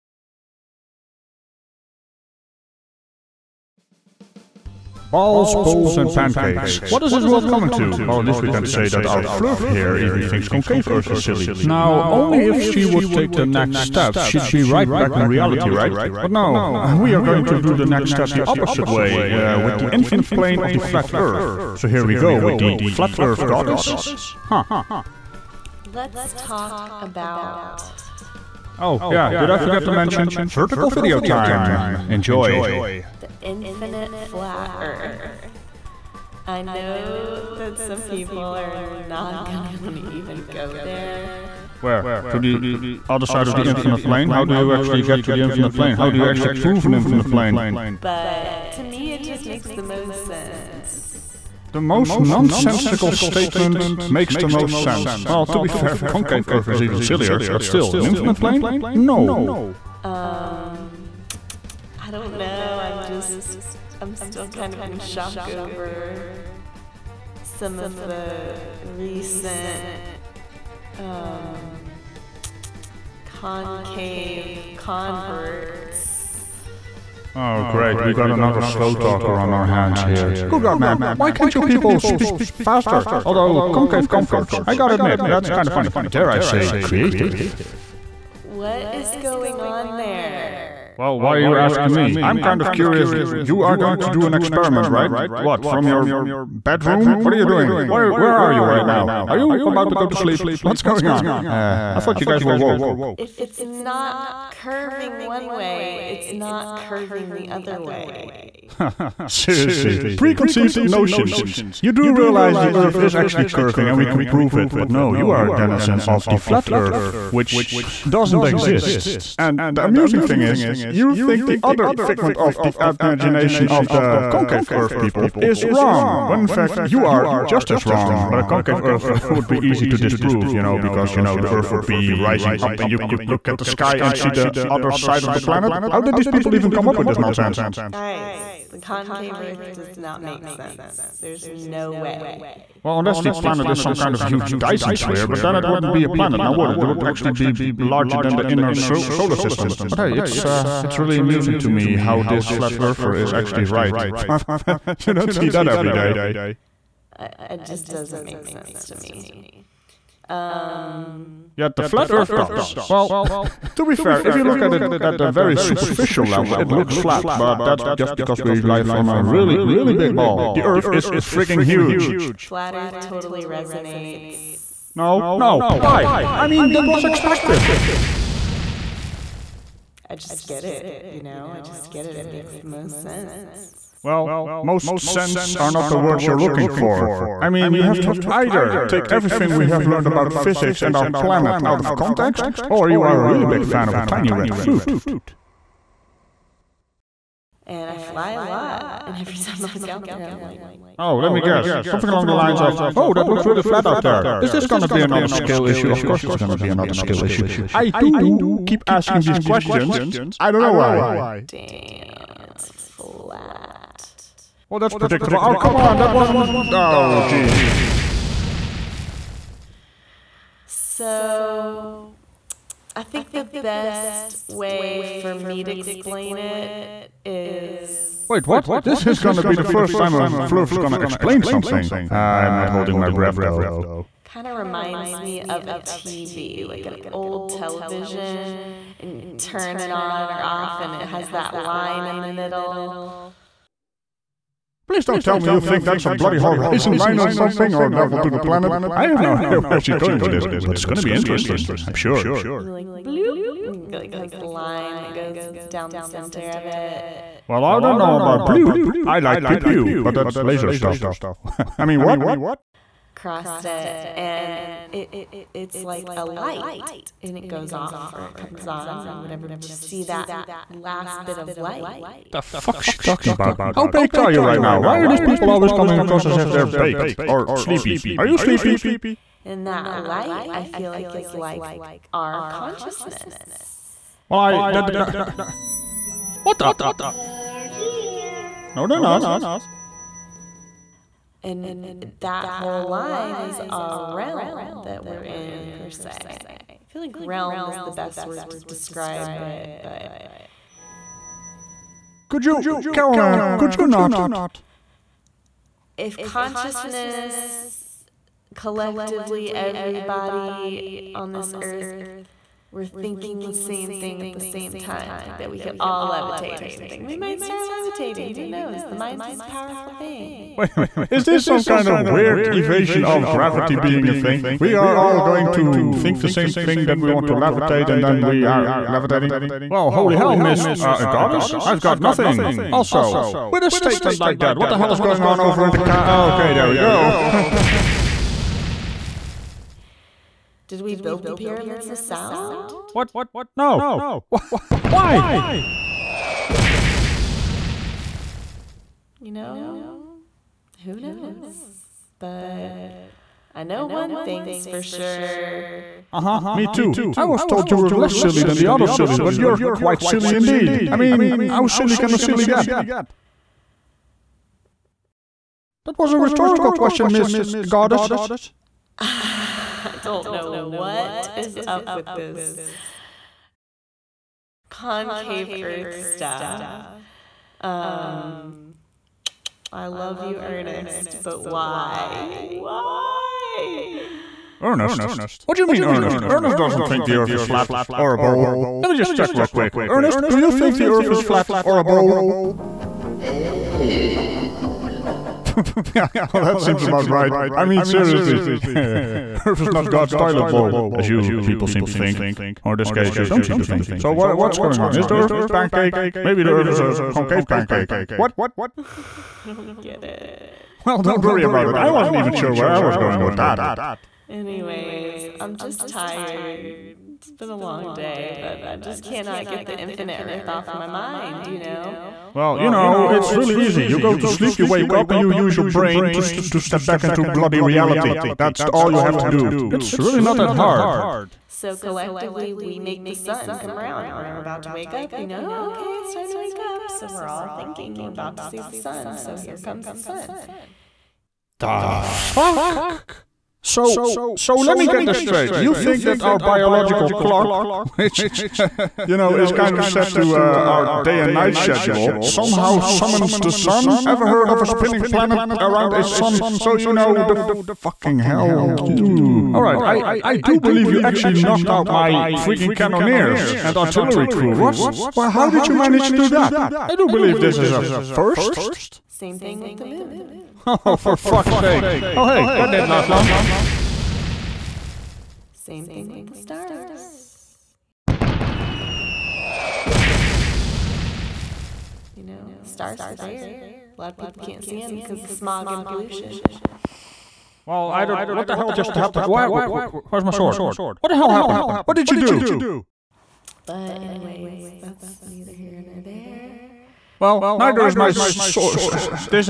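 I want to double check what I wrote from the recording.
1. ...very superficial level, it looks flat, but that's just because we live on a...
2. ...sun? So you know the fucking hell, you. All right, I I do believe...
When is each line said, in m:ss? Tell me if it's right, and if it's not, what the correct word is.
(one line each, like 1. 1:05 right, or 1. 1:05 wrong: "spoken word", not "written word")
1. 2:45 right
2. 7:36 right.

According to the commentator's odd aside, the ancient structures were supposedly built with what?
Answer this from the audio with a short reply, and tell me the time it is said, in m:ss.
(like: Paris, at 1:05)
Sound, at 5:41.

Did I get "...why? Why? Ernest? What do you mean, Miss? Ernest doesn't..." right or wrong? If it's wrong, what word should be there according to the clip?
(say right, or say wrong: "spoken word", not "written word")
wrong: "Ernest", not "Miss".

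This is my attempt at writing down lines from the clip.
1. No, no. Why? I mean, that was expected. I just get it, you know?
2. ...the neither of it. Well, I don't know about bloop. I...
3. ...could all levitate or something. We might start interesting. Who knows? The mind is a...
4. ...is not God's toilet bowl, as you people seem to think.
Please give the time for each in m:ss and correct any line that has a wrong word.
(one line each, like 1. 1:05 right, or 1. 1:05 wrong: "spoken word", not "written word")
1. 2:54 right
2. 4:15 wrong: "center", not "neither"
3. 5:15 wrong: "levitating", not "interesting"
4. 6:39 right.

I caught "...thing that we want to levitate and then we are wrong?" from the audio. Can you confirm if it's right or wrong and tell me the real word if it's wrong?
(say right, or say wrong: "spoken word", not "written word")
wrong: "levitating", not "wrong".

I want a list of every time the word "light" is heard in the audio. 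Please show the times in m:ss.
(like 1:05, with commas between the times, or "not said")
4:26, 4:31, 4:39.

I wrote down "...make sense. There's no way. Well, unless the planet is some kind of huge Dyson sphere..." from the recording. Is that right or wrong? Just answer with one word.
right.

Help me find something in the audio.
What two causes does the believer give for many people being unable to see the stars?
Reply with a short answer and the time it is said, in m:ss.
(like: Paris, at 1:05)
Smog and pollution, at 8:05.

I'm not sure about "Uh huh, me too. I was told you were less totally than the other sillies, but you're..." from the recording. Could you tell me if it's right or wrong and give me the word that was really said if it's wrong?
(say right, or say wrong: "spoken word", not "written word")
wrong: "silly", not "totally".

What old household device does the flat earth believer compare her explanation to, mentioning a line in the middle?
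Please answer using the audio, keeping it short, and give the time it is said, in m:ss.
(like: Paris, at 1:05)
Old television, at 3:57.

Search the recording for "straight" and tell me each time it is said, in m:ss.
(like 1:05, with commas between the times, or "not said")
7:25.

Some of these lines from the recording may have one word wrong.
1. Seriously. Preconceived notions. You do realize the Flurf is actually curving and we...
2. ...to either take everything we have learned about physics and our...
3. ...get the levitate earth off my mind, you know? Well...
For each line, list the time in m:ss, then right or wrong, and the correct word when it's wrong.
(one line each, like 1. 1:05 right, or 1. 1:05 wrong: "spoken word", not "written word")
1. 1:49 wrong: "Earth", not "Flurf"
2. 3:08 right
3. 6:59 wrong: "infinite", not "levitate".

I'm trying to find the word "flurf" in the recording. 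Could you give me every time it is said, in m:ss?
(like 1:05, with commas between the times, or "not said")
0:09, 3:50.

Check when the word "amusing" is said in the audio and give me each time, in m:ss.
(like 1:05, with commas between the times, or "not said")
1:59, 2:31.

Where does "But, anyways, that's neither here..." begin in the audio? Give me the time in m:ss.
8:13.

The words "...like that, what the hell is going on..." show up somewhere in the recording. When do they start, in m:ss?
5:34.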